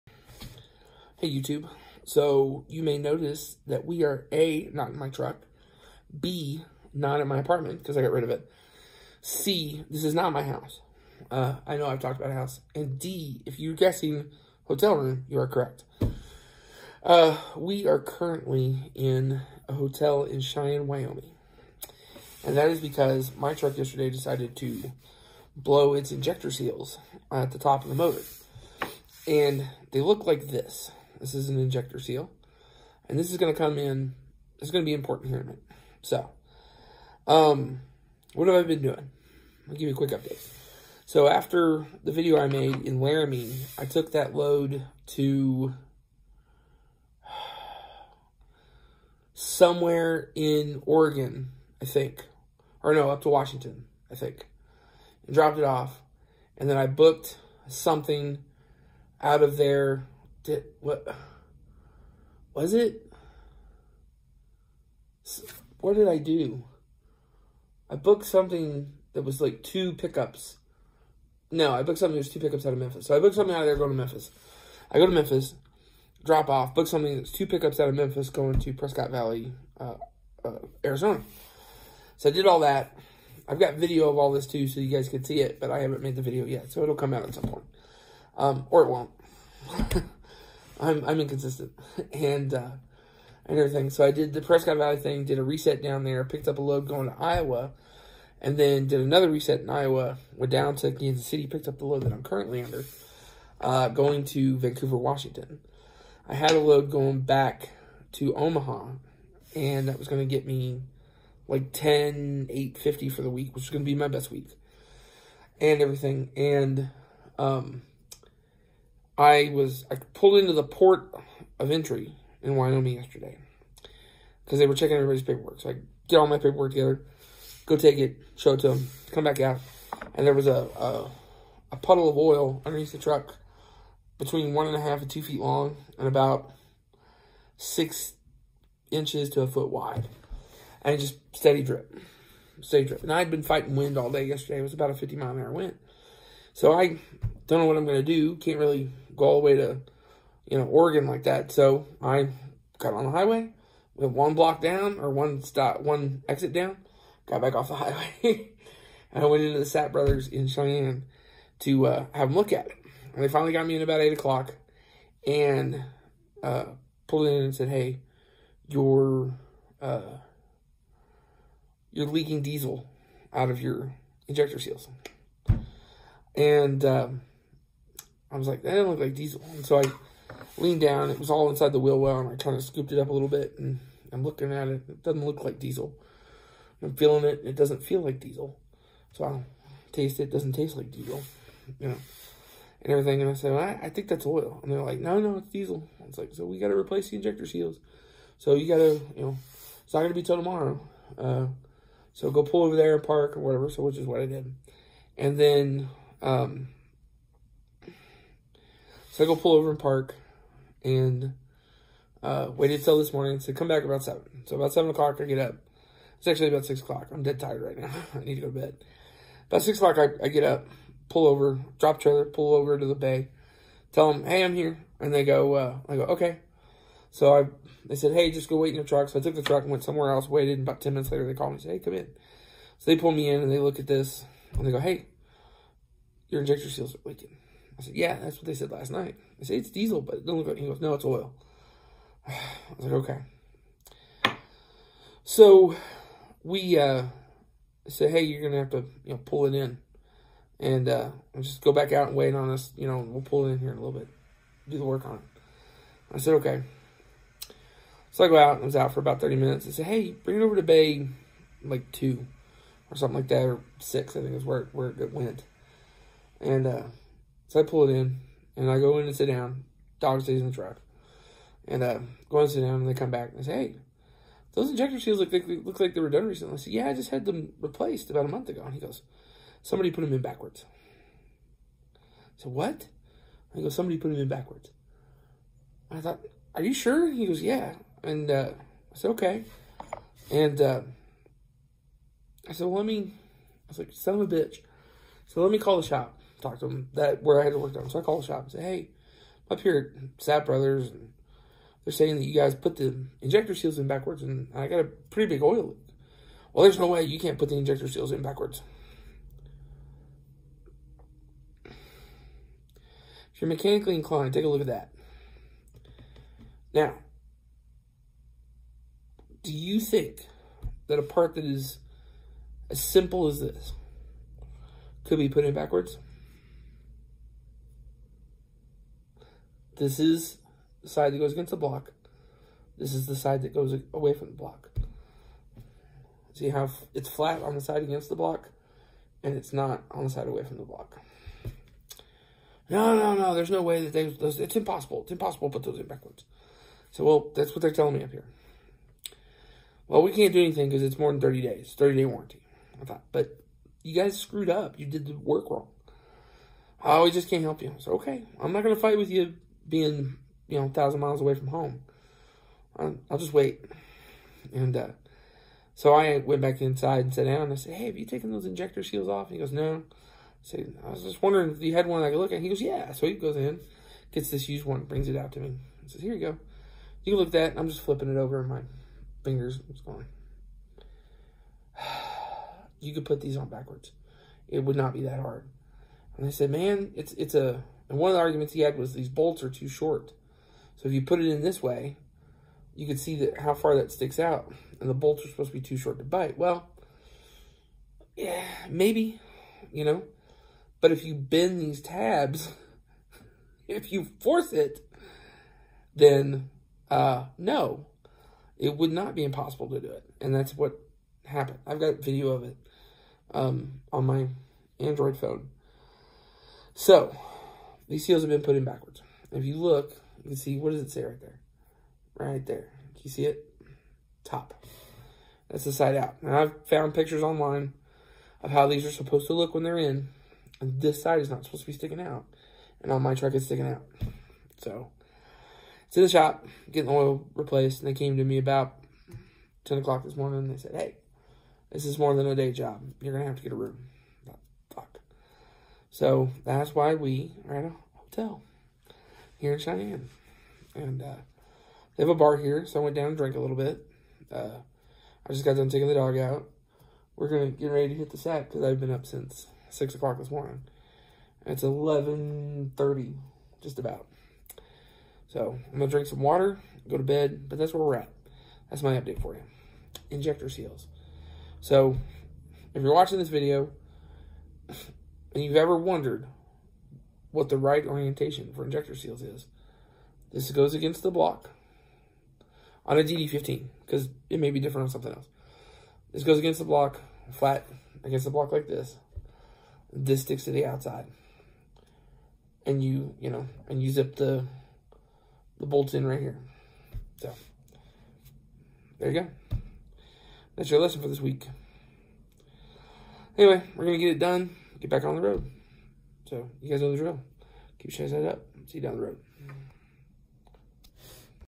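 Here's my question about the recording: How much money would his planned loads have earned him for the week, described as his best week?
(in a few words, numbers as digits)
$10,850.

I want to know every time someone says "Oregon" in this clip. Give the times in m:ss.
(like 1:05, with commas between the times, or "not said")
0:50, 2:30.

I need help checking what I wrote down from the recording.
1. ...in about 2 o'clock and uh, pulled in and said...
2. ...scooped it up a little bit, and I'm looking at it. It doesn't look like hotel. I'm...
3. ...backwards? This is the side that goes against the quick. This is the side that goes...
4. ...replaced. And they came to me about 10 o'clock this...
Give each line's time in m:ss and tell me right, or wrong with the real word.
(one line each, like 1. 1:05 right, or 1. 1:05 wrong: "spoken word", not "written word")
1. 2:43 wrong: "8", not "2"
2. 3:02 wrong: "diesel", not "hotel"
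3. 5:25 wrong: "block", not "quick"
4. 7:17 right.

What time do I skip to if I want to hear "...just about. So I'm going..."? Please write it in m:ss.
7:43.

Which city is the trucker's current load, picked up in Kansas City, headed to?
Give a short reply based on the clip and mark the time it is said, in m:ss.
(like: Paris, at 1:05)
Vancouver, Washington, at 1:44.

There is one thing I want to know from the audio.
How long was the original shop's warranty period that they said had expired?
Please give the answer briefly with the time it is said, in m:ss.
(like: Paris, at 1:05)
30 days, at 5:51.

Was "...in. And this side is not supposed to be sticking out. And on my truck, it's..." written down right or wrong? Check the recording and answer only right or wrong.
right.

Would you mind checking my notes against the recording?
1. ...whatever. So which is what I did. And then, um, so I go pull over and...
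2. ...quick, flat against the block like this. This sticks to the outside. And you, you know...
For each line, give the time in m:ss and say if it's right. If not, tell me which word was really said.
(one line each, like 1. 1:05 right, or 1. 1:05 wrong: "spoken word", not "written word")
1. 3:23 right
2. 8:06 wrong: "block", not "quick".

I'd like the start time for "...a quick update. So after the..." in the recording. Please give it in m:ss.
0:39.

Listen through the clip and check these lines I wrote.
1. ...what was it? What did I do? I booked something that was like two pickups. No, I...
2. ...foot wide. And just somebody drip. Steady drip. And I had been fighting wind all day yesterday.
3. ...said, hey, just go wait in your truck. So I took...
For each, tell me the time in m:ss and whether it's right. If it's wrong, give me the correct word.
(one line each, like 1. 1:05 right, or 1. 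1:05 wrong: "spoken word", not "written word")
1. 1:00 right
2. 2:19 wrong: "steady", not "somebody"
3. 3:47 right.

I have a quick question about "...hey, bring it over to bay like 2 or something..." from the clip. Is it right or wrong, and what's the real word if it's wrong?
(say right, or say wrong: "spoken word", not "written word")
right.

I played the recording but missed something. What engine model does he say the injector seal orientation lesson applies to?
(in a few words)
DD15.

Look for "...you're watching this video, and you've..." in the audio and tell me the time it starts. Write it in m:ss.
7:52.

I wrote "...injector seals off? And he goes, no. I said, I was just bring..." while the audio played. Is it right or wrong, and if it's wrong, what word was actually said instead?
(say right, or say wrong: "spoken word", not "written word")
wrong: "wondering", not "bring".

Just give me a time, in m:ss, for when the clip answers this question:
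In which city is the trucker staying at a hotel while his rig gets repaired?
0:20.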